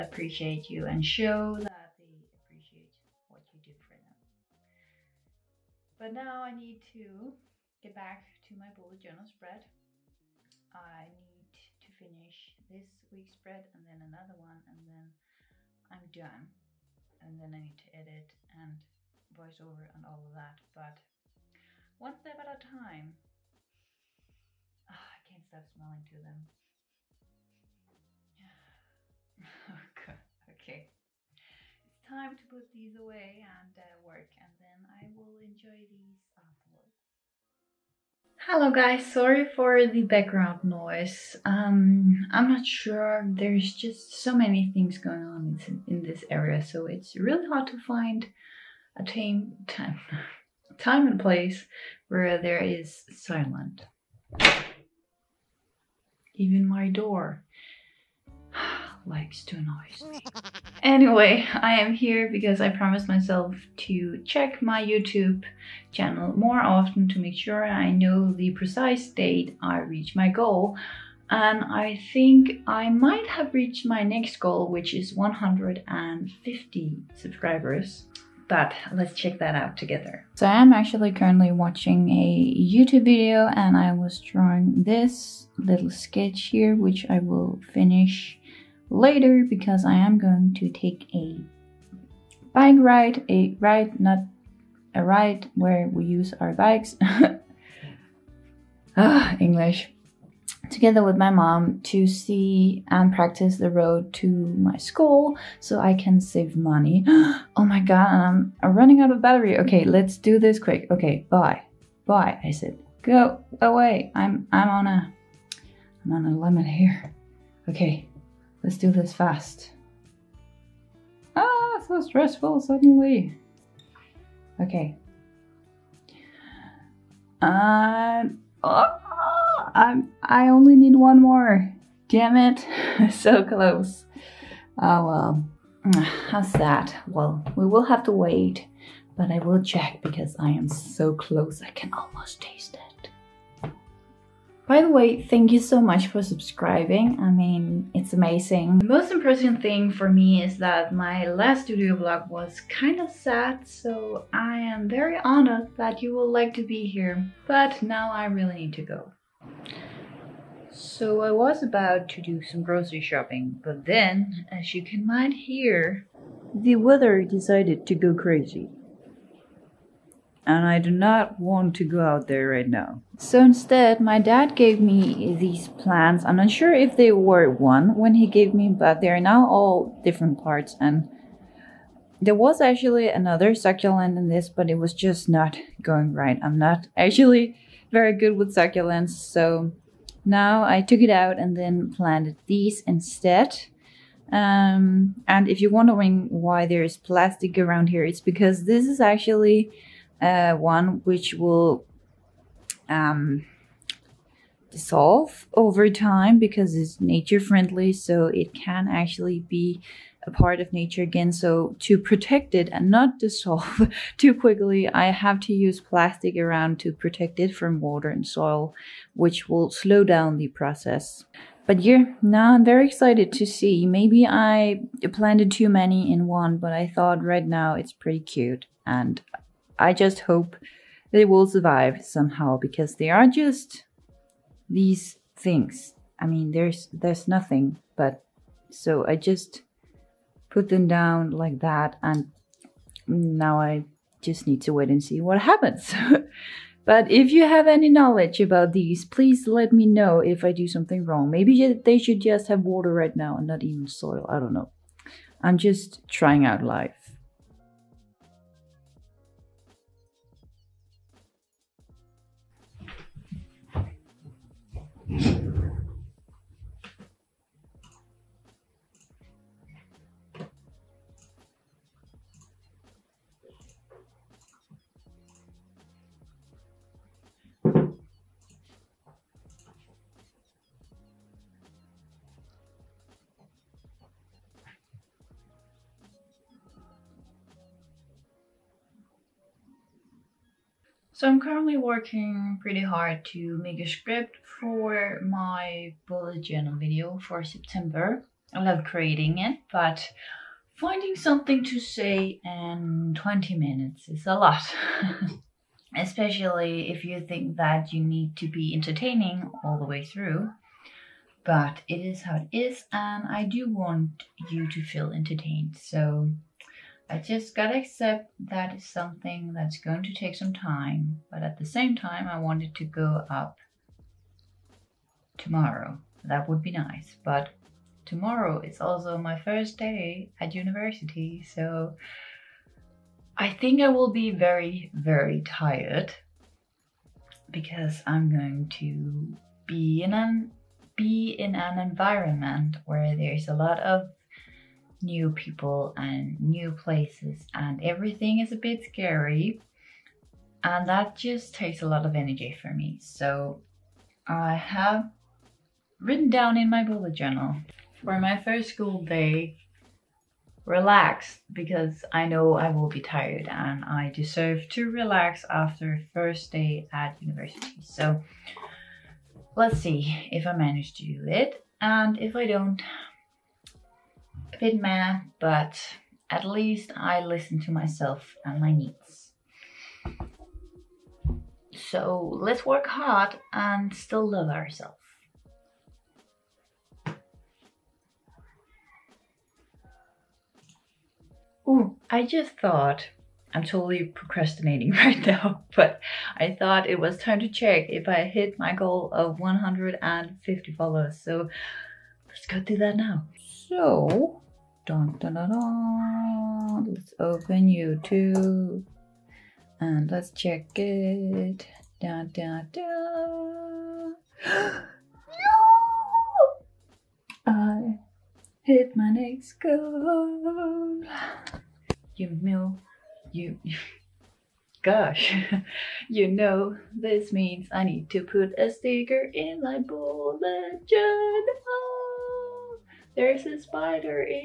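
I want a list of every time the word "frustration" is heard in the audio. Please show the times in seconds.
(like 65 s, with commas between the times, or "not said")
not said.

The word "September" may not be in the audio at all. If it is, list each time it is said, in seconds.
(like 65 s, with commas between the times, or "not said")
297 s.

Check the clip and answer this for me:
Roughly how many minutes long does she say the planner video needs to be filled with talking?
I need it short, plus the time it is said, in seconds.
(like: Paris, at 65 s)
20 minutes, at 303 s.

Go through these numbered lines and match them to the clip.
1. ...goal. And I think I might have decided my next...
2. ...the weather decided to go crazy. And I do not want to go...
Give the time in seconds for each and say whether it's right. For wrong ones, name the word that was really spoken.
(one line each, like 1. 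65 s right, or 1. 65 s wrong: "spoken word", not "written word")
1. 70 s wrong: "reached", not "decided"
2. 166 s right.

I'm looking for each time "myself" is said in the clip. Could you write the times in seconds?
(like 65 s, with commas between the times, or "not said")
63 s, 377 s.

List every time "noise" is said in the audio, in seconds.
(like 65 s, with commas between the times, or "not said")
40 s, 59 s.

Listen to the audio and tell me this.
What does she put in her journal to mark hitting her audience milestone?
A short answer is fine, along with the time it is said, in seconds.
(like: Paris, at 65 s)
a sticker, at 428 s.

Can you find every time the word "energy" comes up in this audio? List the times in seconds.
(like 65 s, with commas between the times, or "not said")
352 s.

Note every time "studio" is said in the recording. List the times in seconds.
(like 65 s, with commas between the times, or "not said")
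151 s.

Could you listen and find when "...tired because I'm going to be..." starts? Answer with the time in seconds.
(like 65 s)
335 s.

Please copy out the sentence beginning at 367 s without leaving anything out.
So let's see if I manage to do it.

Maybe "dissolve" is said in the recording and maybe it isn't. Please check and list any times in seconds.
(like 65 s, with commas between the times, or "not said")
204 s, 213 s.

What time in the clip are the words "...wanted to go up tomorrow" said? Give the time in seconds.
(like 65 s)
322 s.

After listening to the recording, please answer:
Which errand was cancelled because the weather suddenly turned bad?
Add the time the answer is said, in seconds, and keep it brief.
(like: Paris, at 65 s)
grocery shopping, at 162 s.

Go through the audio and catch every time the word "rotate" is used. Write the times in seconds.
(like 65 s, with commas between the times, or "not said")
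not said.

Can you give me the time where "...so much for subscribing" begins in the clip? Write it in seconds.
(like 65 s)
145 s.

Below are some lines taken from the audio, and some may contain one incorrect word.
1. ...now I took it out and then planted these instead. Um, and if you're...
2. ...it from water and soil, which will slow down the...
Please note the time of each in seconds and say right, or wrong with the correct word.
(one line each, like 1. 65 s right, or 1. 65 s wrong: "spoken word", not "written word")
1. 190 s right
2. 217 s right.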